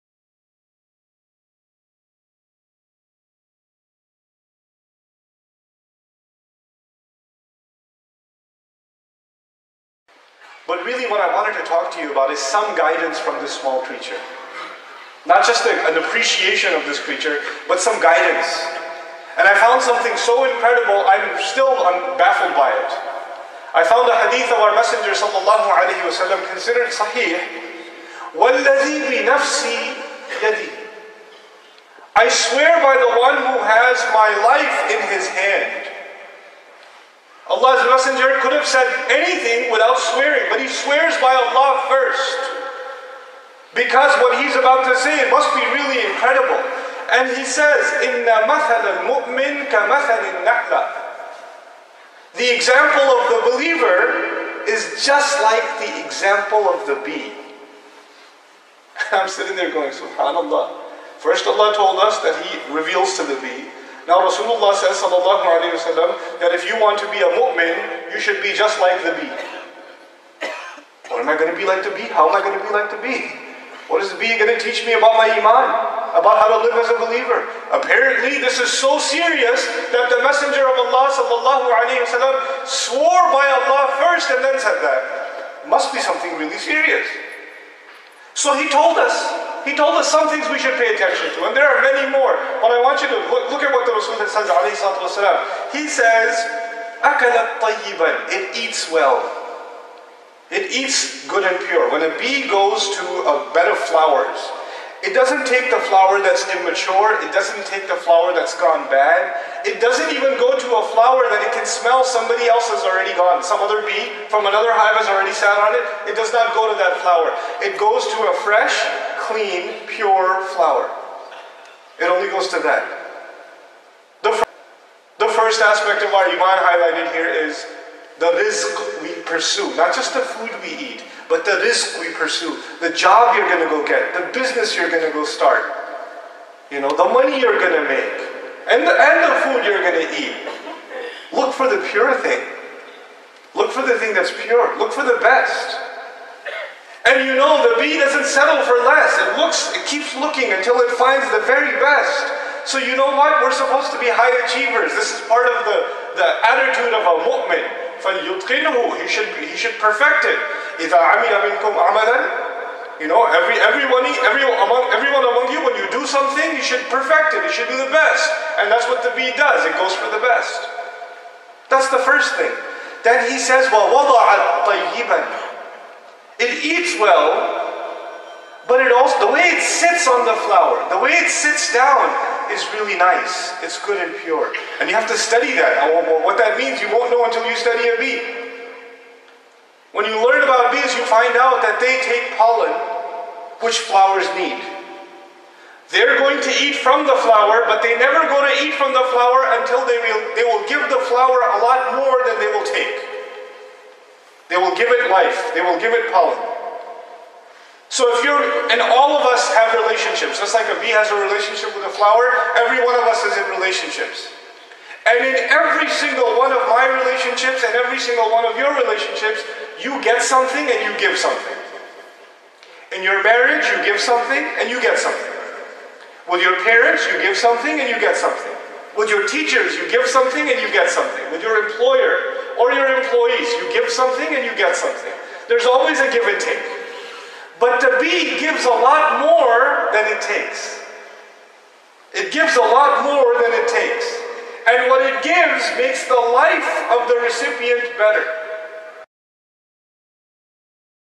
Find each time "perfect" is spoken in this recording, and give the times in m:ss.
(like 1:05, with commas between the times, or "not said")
2:39, 2:46.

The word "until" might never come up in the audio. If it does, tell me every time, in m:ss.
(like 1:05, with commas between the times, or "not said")
2:30, 3:07, 3:19.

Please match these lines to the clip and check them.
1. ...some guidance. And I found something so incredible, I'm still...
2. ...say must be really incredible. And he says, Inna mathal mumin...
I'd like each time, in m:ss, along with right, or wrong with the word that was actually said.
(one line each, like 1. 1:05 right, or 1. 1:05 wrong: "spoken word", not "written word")
1. 0:17 right
2. 0:44 right.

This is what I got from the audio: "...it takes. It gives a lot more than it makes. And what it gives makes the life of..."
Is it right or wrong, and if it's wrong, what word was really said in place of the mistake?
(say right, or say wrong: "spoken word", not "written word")
wrong: "takes", not "makes".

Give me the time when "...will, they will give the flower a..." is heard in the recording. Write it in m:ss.
3:20.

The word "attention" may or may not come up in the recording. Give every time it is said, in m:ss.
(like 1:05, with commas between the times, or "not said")
1:30.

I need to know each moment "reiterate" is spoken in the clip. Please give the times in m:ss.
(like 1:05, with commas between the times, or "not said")
not said.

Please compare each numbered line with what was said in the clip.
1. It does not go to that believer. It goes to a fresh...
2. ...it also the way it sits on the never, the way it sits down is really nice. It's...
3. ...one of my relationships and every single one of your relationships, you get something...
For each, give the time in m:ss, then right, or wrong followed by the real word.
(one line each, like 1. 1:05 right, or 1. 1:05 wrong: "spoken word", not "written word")
1. 1:56 wrong: "flower", not "believer"
2. 2:58 wrong: "flower", not "never"
3. 3:36 right.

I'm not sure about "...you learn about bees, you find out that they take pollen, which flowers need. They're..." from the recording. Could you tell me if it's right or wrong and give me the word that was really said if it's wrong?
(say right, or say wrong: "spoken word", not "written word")
right.